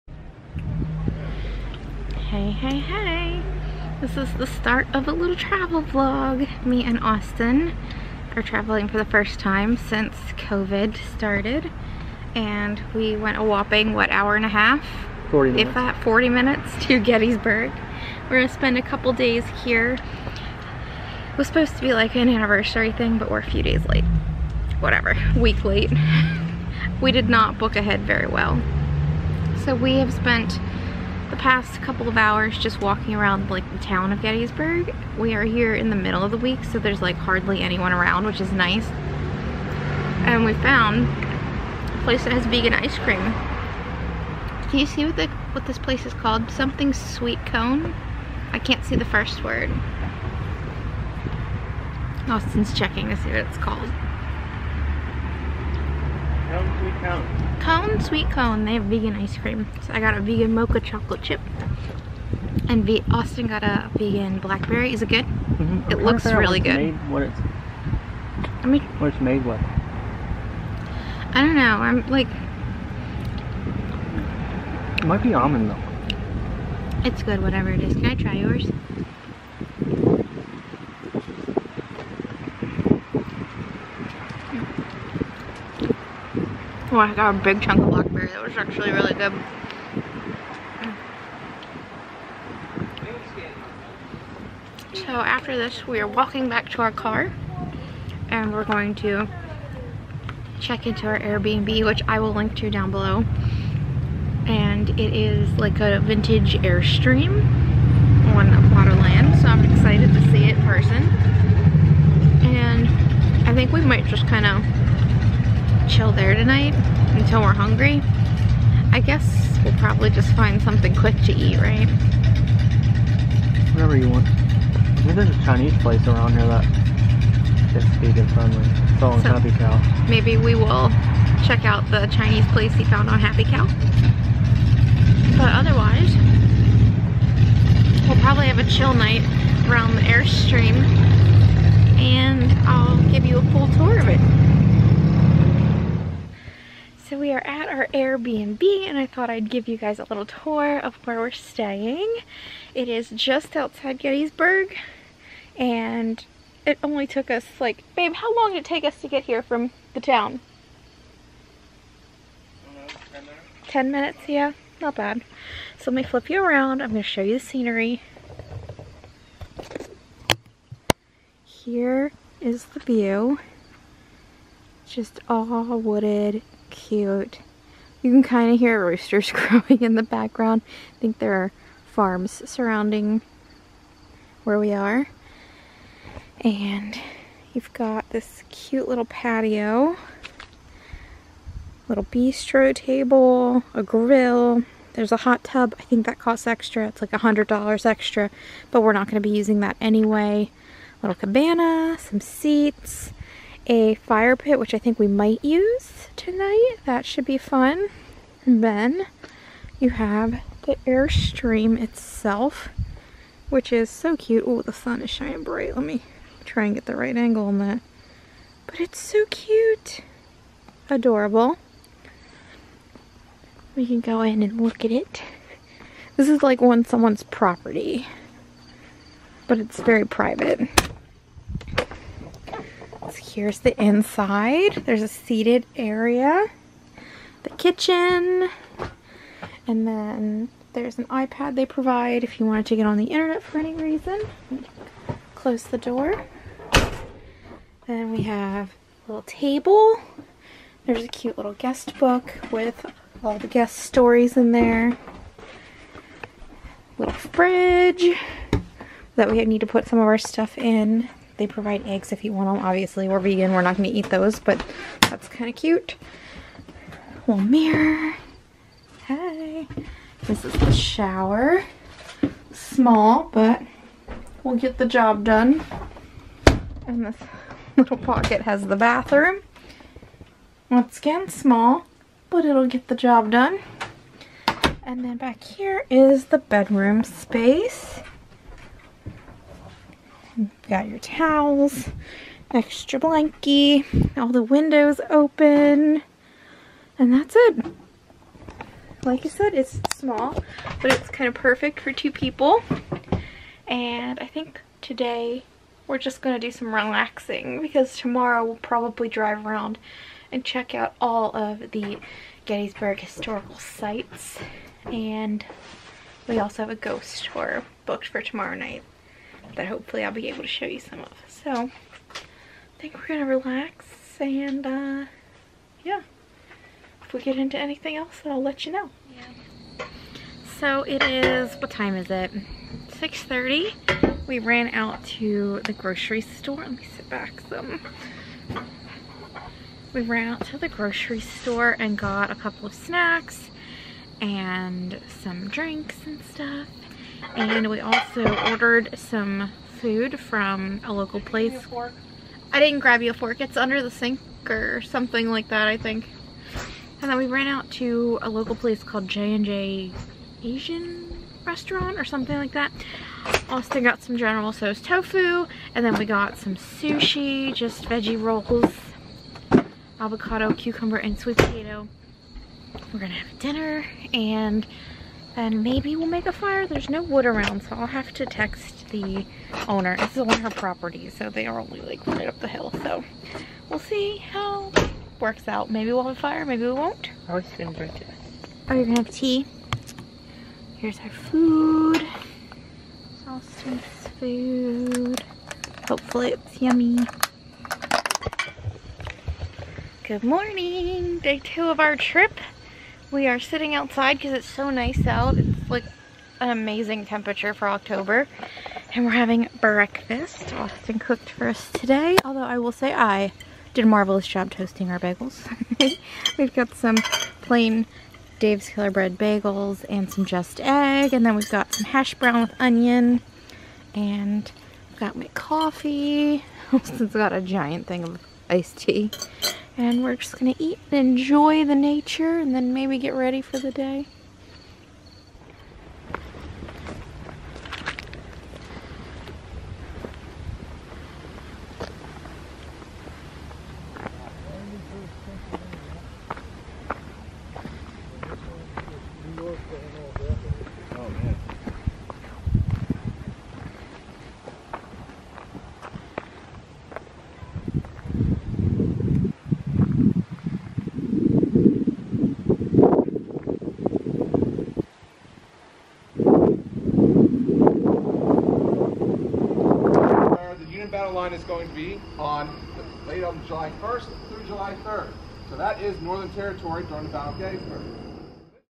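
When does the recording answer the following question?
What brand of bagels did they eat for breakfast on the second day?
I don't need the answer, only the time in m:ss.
6:58.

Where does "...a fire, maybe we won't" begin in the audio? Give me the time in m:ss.
6:26.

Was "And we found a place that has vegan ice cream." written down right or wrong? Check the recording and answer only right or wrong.
right.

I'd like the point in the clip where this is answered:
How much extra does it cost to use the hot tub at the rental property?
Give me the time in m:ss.
3:17.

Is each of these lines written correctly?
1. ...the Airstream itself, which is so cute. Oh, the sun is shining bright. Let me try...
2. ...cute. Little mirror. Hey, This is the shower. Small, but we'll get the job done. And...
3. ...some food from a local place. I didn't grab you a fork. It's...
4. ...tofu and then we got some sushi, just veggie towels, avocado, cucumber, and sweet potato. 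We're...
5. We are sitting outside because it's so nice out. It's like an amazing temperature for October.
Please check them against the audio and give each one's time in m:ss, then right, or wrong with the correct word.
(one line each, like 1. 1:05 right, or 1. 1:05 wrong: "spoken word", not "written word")
1. 3:30 right
2. 4:25 right
3. 5:48 right
4. 6:04 wrong: "rolls", not "towels"
5. 6:43 right.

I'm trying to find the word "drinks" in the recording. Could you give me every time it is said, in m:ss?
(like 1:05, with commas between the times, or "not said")
5:45, 6:27.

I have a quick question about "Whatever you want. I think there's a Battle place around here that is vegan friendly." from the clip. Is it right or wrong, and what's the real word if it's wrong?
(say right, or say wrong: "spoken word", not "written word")
wrong: "Chinese", not "Battle".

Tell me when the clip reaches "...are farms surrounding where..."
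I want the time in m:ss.
3:01.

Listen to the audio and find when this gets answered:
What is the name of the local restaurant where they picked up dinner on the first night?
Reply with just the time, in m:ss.
5:59.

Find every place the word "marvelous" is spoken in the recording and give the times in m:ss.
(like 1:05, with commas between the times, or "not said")
6:53.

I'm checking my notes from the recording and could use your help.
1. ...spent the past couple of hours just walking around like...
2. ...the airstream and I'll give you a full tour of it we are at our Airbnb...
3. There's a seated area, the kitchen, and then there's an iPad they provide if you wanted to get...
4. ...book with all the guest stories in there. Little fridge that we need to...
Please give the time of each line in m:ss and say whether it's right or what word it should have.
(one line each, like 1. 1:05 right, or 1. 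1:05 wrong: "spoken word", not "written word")
1. 0:30 right
2. 2:19 right
3. 3:54 right
4. 4:11 right.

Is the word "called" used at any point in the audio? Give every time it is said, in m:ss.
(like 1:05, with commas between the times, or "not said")
0:46, 0:53, 5:58.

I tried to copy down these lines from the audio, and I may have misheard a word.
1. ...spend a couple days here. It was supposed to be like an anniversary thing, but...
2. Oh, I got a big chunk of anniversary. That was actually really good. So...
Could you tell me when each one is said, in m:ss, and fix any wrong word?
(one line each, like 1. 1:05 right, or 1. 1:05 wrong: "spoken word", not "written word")
1. 0:18 right
2. 1:26 wrong: "blackberry", not "anniversary".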